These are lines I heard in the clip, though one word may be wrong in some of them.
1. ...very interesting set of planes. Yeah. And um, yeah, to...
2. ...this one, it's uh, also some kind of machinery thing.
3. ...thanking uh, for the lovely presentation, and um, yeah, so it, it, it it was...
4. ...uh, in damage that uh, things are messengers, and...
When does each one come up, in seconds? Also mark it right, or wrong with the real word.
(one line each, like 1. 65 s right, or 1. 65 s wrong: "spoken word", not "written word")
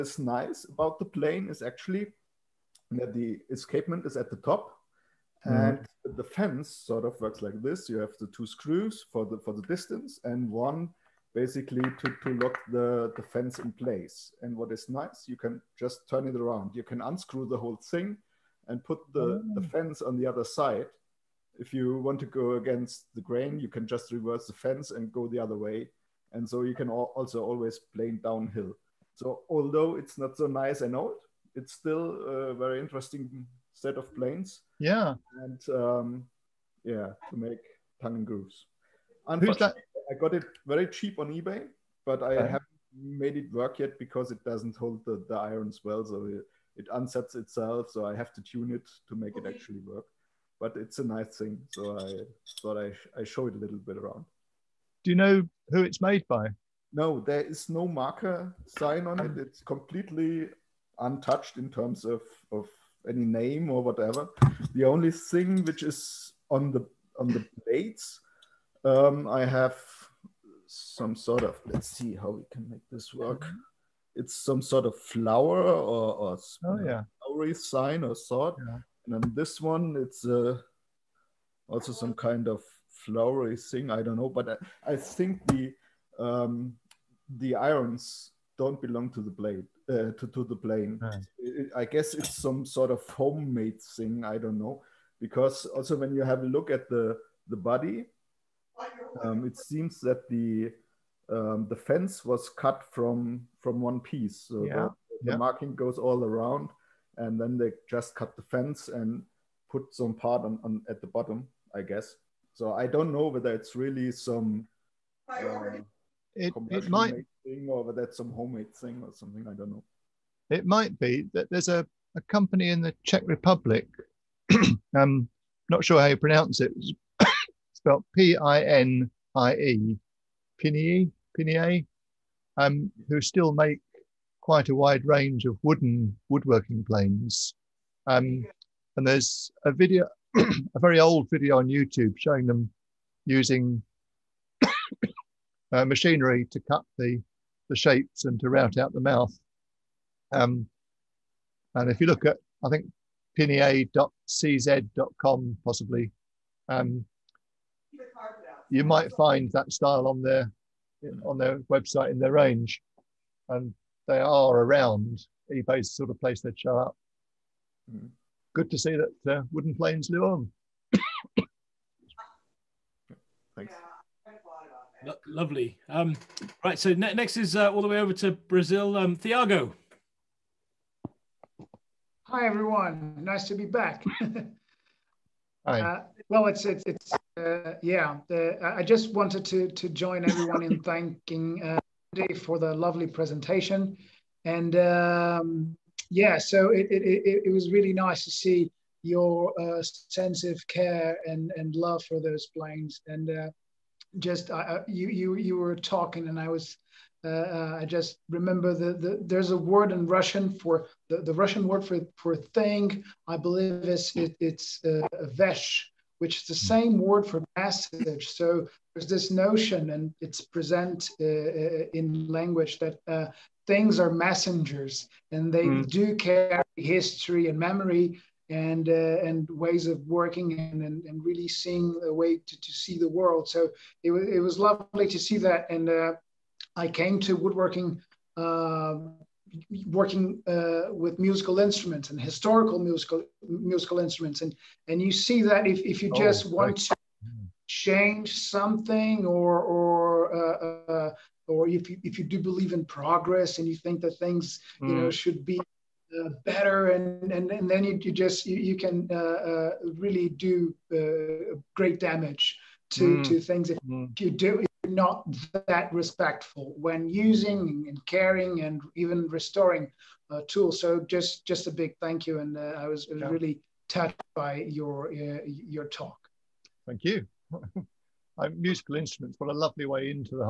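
1. 32 s right
2. 79 s wrong: "flowery", not "machinery"
3. 190 s right
4. 221 s wrong: "language", not "damage".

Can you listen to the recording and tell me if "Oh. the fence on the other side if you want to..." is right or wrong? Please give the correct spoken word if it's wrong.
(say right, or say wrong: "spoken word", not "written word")
right.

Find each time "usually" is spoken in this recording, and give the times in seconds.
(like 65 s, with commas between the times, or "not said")
not said.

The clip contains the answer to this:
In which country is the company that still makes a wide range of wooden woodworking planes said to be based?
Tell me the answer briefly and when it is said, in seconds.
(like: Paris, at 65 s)
Czech Republic, at 123 s.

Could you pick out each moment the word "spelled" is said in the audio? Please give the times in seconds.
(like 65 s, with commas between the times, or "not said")
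127 s.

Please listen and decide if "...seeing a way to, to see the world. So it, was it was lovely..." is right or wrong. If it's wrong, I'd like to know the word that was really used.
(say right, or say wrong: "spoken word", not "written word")
right.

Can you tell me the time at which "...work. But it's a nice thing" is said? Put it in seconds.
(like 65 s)
49 s.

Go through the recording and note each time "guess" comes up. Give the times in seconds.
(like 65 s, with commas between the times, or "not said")
91 s, 111 s.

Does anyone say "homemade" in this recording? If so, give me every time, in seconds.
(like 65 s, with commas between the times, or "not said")
93 s, 118 s.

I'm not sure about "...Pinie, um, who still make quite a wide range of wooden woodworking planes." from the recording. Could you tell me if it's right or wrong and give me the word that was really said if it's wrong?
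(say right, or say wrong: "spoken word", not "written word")
right.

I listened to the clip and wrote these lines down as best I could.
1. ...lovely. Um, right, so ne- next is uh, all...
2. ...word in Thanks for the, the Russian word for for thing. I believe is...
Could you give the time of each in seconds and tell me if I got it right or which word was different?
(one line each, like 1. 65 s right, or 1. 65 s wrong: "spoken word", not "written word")
1. 175 s right
2. 209 s wrong: "Russian", not "Thanks".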